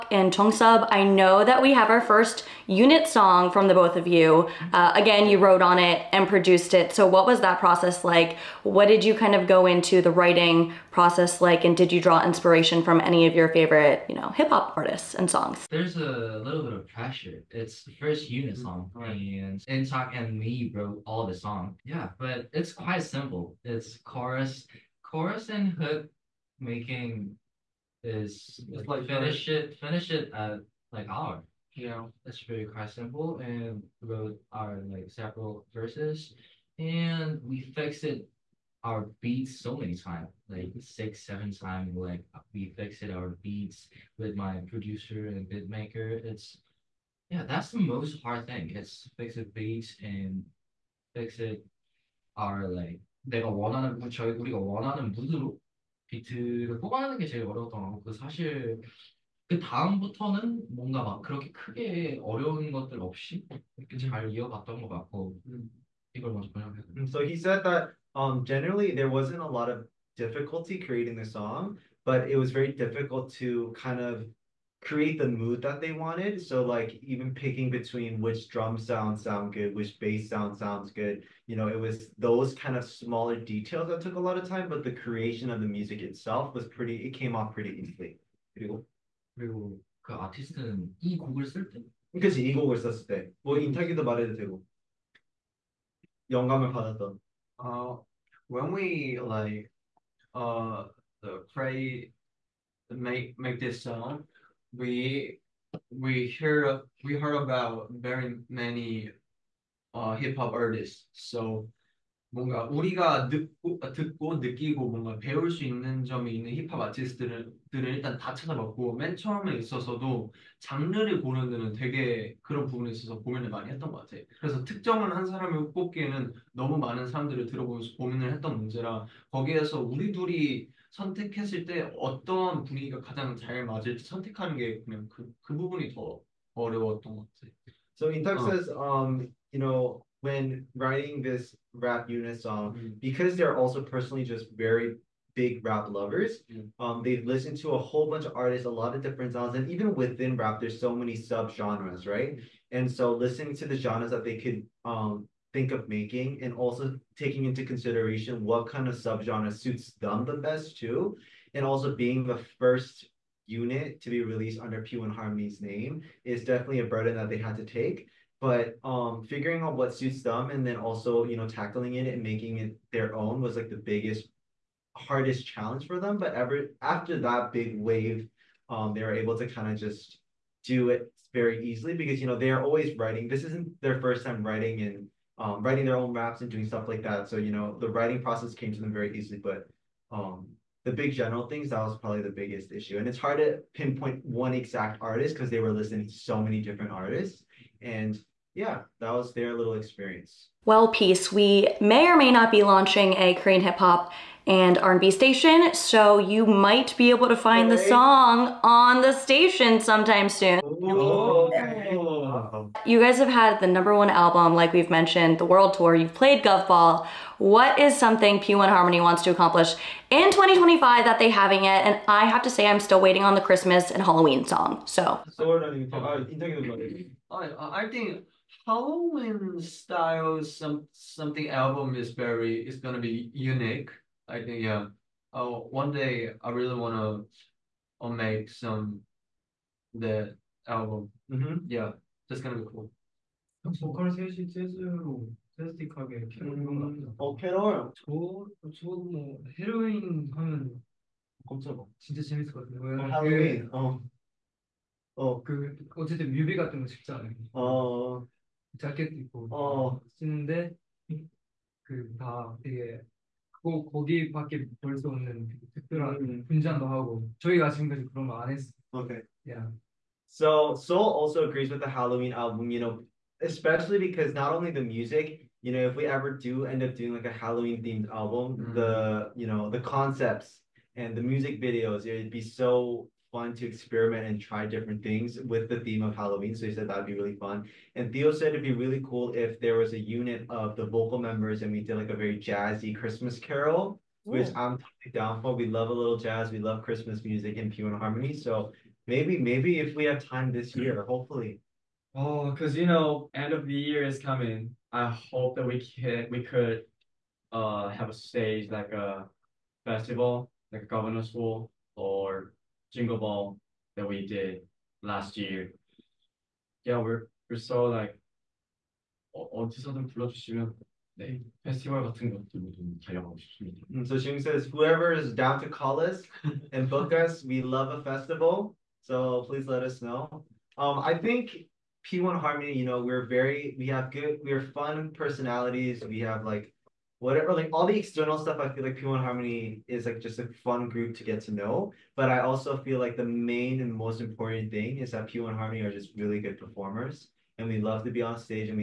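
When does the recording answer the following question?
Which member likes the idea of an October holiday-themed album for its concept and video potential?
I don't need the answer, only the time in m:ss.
4:30.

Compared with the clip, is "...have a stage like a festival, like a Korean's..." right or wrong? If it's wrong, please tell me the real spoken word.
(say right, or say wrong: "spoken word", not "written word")
wrong: "Governor", not "Korean".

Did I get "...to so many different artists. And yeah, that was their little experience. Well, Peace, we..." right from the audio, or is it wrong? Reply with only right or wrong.
right.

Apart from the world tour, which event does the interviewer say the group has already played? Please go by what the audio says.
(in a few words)
Gov Ball.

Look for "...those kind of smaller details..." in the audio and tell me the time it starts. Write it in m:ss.
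1:22.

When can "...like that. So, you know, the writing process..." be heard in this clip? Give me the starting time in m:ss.
3:06.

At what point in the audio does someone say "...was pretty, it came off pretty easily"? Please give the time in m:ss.
1:26.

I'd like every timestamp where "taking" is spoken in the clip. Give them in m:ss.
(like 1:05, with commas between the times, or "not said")
2:37.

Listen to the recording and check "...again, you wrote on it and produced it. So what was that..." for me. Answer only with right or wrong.
right.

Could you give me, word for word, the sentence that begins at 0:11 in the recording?
And did you draw inspiration from any of your favorite, you know, hip hop artists and songs?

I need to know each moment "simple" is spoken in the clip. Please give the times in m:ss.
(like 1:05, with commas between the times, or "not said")
0:23, 0:32.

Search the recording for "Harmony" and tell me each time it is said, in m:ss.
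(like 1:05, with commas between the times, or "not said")
2:45, 3:38, 4:57, 5:32, 5:39, 5:45.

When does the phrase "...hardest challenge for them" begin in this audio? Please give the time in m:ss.
2:54.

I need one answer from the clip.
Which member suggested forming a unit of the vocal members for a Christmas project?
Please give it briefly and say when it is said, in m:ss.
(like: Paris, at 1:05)
Theo, at 4:48.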